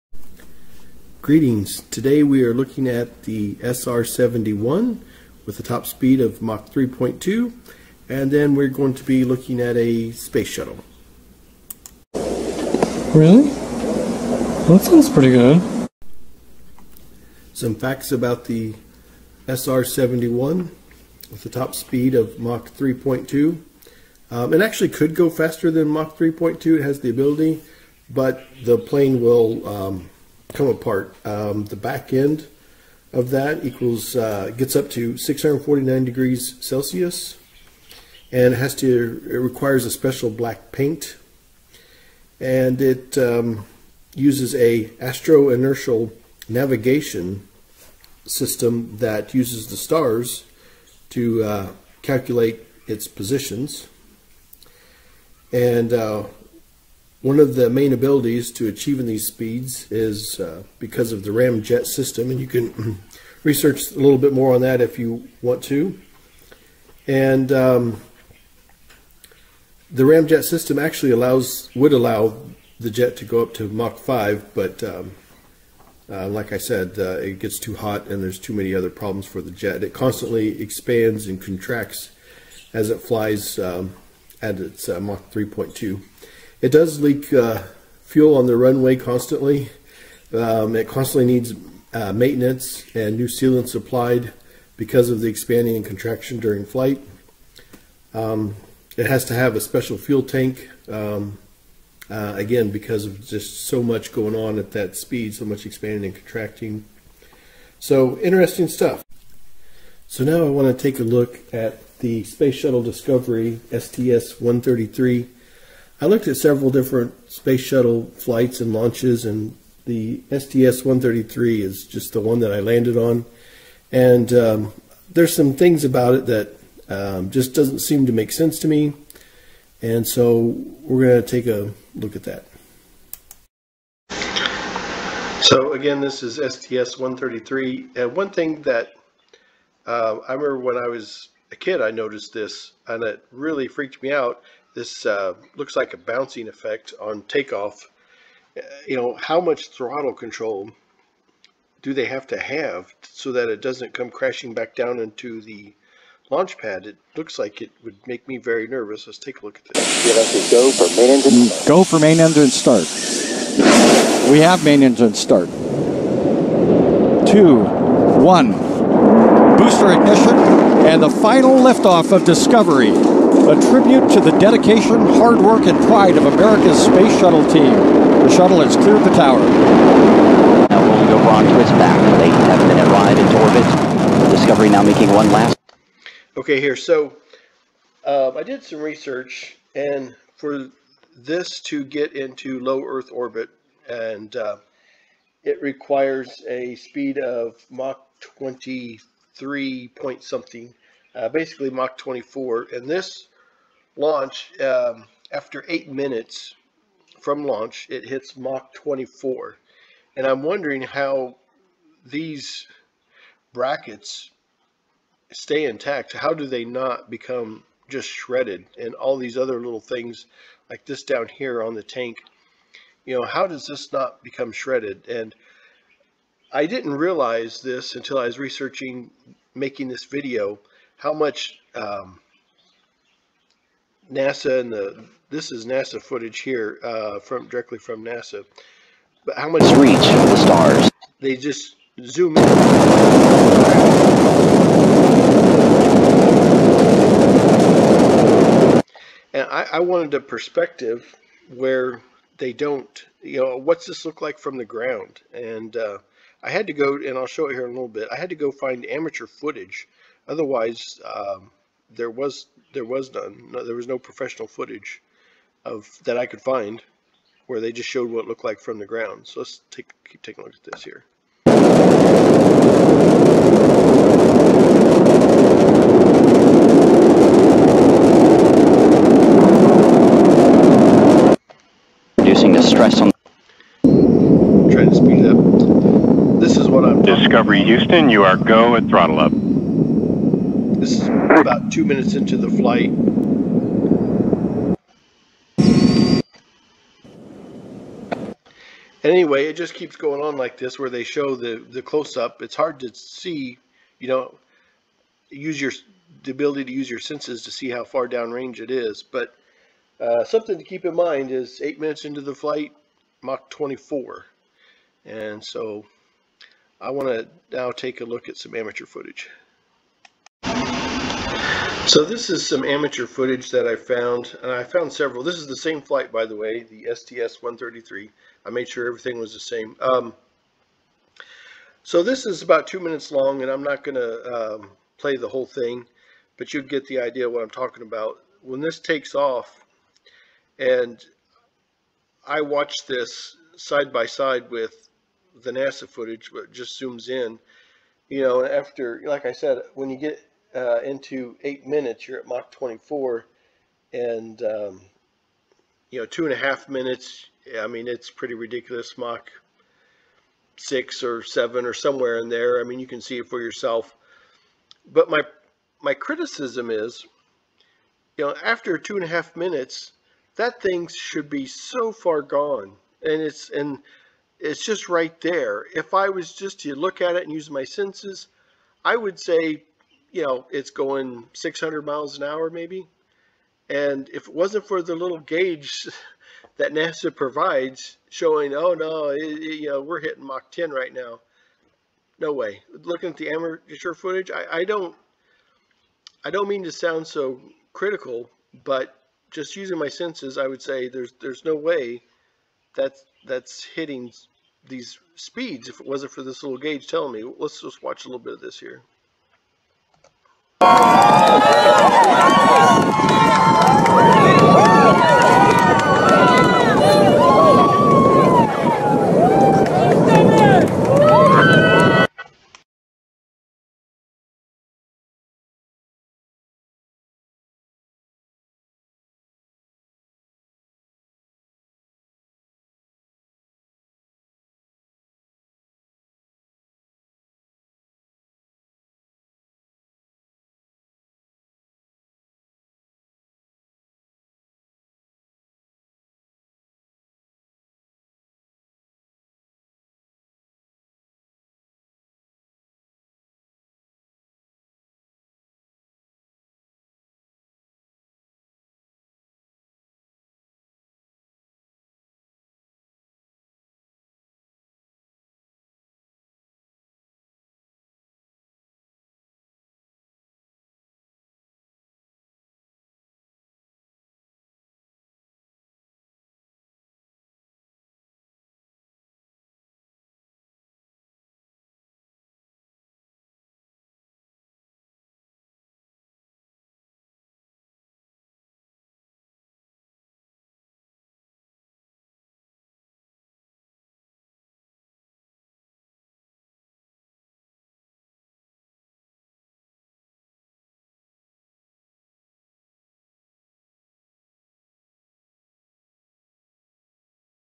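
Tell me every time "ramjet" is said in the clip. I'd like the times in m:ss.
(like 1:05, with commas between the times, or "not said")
1:01, 1:10.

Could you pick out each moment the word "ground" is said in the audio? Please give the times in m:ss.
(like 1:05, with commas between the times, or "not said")
4:14, 4:28.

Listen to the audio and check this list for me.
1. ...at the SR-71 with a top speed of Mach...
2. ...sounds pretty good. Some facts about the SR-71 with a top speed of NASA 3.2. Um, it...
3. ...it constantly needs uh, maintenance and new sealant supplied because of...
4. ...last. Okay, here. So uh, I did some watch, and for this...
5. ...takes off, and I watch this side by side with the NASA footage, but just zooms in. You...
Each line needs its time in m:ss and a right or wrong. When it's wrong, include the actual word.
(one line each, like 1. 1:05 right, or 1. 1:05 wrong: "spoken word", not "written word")
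1. 0:02 right
2. 0:14 wrong: "Mach", not "NASA"
3. 1:30 right
4. 3:05 wrong: "research", not "watch"
5. 5:38 right.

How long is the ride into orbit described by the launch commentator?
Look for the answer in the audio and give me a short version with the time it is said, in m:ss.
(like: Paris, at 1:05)
8 and a half minutes, at 3:02.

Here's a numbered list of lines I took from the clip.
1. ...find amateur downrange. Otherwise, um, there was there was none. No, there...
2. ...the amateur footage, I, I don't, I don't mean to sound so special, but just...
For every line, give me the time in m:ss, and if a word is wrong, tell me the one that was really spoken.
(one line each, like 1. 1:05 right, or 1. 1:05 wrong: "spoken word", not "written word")
1. 4:18 wrong: "footage", not "downrange"
2. 6:33 wrong: "critical", not "special".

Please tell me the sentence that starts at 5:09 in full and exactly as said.
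But uh, something to keep in mind is eight minutes into the flight, Mach 24.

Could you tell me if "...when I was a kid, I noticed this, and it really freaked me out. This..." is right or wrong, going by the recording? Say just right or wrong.
right.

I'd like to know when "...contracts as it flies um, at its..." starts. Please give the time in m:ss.
1:21.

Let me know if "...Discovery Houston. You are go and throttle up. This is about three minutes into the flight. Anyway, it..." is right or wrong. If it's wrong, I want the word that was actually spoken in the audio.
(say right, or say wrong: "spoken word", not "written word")
wrong: "two", not "three".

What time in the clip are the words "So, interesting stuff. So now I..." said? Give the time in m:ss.
1:47.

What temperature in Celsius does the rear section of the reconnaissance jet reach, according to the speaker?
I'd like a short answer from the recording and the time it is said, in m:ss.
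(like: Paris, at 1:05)
649 degrees Celsius, at 0:35.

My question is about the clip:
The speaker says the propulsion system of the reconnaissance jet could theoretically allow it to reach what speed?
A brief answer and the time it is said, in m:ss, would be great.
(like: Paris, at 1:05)
Mach 5, at 1:13.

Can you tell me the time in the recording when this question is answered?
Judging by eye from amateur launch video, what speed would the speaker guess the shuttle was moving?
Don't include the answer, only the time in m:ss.
6:21.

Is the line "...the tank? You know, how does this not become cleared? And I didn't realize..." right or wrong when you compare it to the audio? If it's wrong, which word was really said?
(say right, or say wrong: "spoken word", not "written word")
wrong: "shredded", not "cleared".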